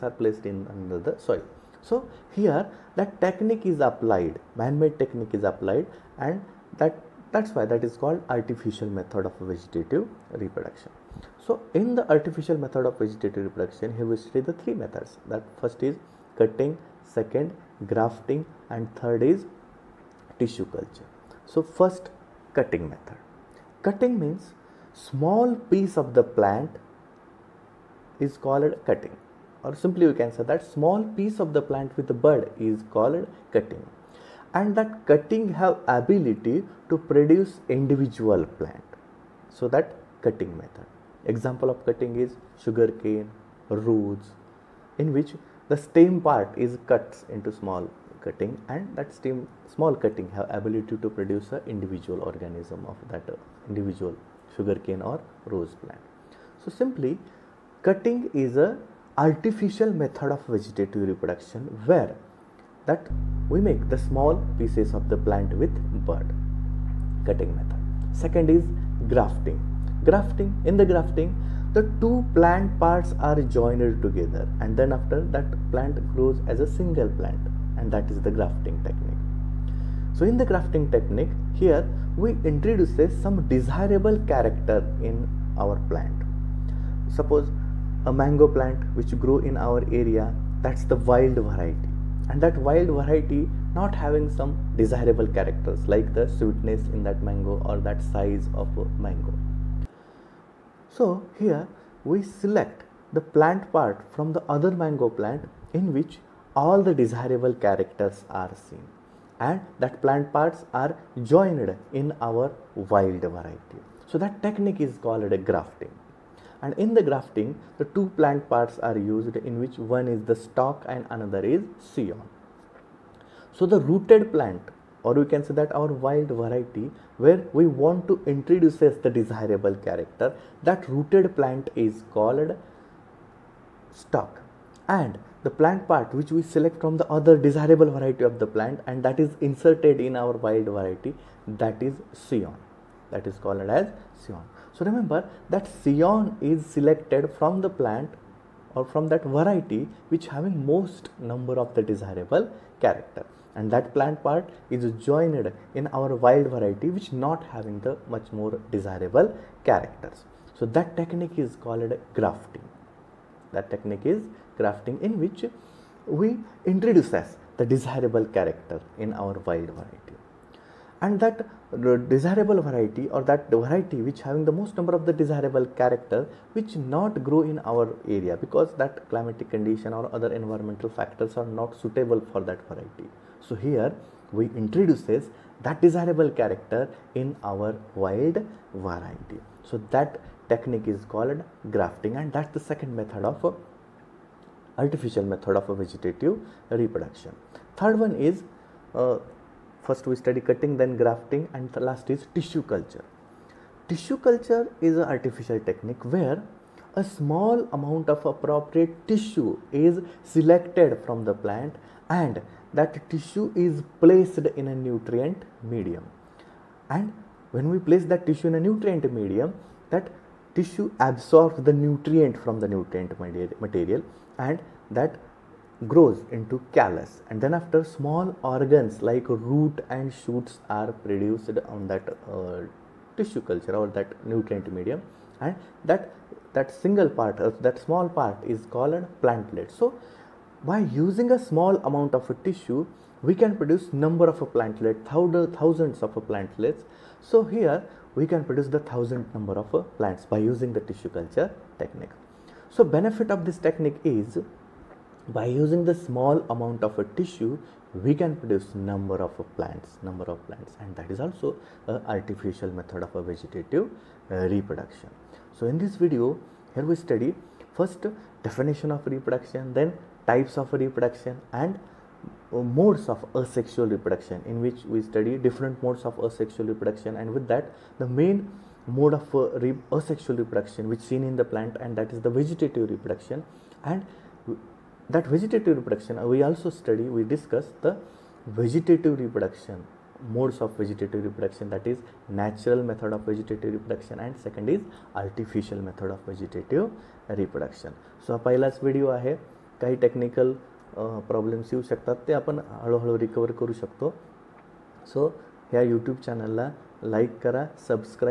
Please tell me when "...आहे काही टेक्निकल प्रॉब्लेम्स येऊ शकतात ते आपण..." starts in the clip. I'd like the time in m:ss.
4:59.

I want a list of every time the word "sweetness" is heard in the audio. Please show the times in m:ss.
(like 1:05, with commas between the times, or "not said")
1:36.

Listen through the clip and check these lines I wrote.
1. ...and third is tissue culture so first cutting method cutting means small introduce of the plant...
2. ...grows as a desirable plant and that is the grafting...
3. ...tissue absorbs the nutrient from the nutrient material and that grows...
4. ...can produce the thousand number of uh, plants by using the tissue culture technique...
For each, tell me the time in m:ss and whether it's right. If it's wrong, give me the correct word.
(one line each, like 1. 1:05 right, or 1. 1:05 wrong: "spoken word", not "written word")
1. 0:18 wrong: "piece", not "introduce"
2. 1:16 wrong: "single", not "desirable"
3. 3:40 right
4. 4:08 right.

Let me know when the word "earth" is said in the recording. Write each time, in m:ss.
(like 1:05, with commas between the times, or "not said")
not said.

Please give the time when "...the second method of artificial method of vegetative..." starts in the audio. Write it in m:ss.
3:12.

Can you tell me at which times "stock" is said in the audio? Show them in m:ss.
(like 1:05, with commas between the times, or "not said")
2:00, 2:14.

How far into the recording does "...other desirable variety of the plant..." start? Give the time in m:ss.
2:17.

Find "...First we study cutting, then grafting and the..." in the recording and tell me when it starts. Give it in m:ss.
3:19.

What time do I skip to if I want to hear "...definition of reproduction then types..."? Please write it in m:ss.
4:28.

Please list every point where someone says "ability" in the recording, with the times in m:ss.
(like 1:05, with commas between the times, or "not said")
0:35, 0:50.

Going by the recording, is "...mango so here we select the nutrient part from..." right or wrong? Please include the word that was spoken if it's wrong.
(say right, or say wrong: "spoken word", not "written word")
wrong: "plant", not "nutrient".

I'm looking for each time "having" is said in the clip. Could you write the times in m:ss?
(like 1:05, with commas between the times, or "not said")
1:34, 2:30, 2:37, 2:54.